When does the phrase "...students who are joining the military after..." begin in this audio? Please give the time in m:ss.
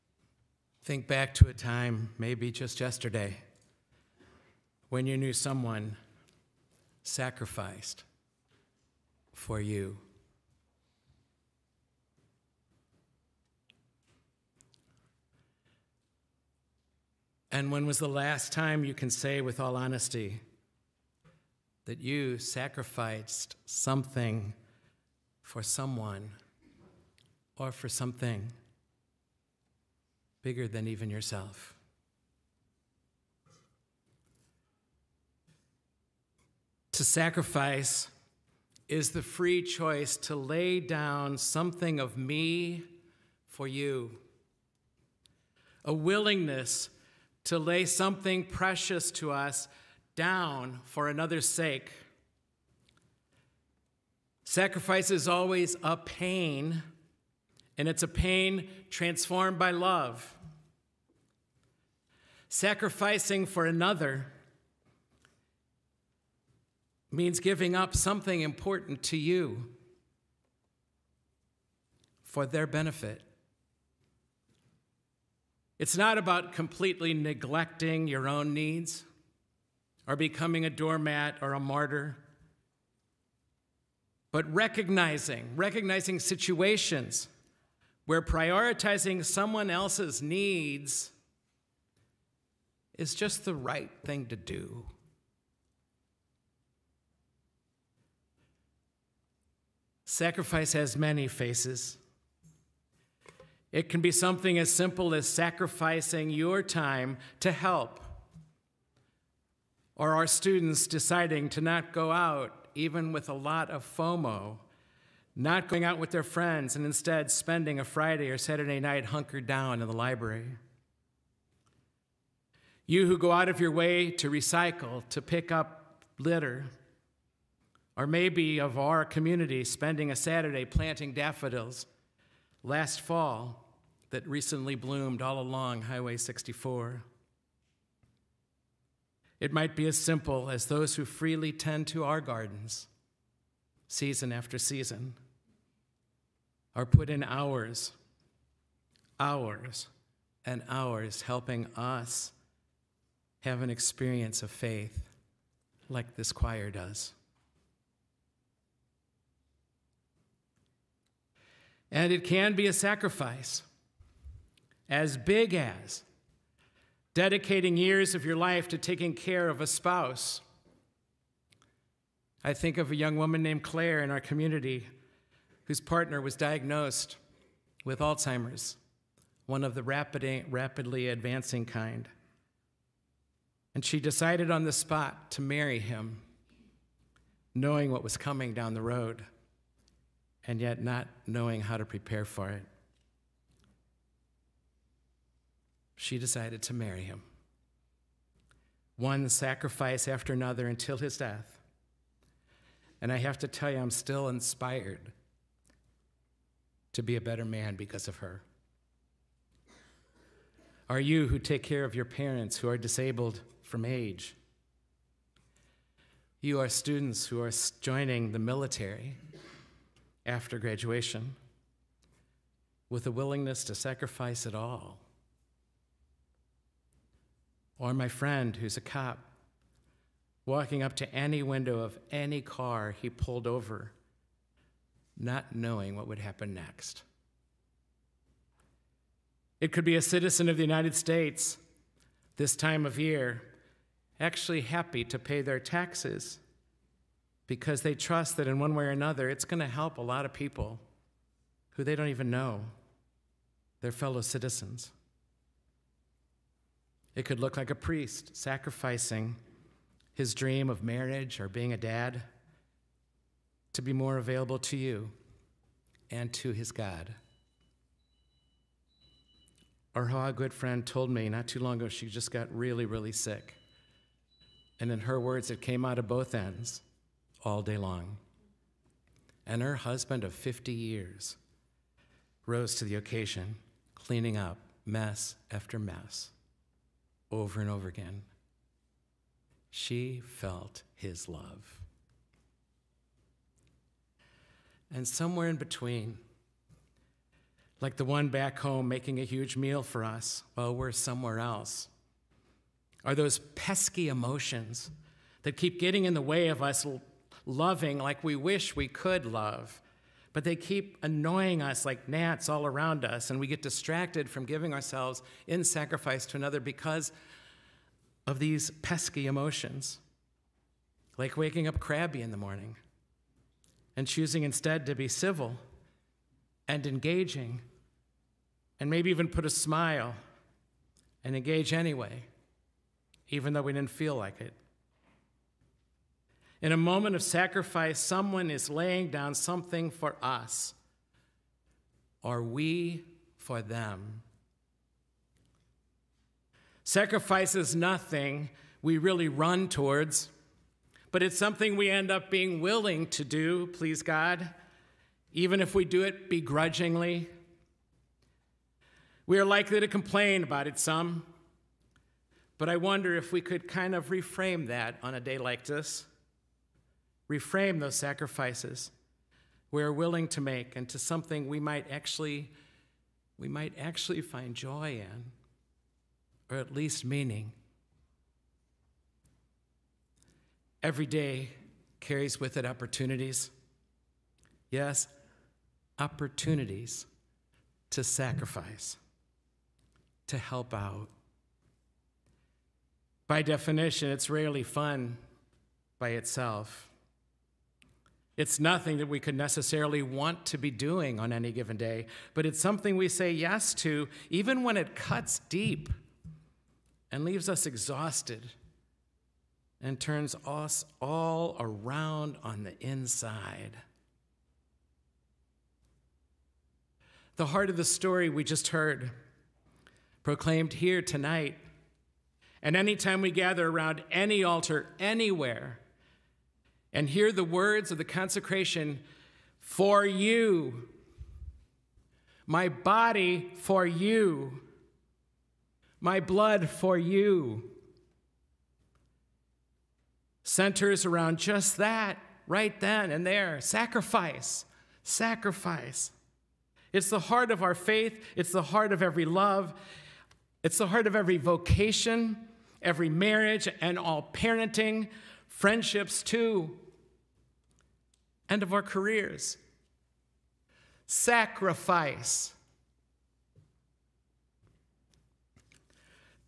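3:36.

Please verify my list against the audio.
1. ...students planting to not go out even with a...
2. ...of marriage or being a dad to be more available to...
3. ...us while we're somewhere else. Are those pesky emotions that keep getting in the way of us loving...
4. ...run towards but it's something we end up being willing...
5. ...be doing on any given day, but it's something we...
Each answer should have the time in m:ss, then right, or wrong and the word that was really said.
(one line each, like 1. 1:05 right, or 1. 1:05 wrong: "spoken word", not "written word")
1. 1:50 wrong: "deciding", not "planting"
2. 4:20 right
3. 5:00 right
4. 5:49 right
5. 6:40 right.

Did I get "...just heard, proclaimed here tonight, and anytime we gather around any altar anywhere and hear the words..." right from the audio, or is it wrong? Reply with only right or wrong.
right.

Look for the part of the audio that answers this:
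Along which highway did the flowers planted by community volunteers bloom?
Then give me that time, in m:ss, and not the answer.
2:15.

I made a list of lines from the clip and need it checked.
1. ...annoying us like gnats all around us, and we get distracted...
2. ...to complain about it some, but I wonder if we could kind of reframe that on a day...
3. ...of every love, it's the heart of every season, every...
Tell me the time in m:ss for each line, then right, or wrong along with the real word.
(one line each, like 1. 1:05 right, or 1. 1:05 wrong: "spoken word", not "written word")
1. 5:11 right
2. 5:59 right
3. 7:28 wrong: "vocation", not "season".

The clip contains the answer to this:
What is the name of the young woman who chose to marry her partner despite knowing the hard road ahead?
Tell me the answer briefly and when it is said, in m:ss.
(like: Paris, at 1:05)
Claire, at 2:53.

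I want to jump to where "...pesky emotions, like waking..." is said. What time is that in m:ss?
5:18.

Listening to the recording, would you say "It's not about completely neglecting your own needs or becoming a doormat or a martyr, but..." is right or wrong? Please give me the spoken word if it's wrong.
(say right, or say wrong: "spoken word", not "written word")
right.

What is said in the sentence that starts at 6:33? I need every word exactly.
By definition, it's rarely fun by itself.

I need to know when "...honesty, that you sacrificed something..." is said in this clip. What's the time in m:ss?
0:19.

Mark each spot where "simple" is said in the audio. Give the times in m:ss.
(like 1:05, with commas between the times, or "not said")
1:44, 2:19.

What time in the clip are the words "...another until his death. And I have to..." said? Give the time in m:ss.
3:20.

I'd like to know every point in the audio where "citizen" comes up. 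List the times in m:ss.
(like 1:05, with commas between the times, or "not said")
4:00, 4:14.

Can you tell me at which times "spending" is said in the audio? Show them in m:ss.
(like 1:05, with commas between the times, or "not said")
1:57, 2:09.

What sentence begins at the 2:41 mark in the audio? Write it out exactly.
And it can be a sacrifice as big as dedicating years of your life to taking care of a spouse.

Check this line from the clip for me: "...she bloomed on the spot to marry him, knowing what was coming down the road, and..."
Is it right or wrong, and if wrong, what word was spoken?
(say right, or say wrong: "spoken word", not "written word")
wrong: "decided", not "bloomed".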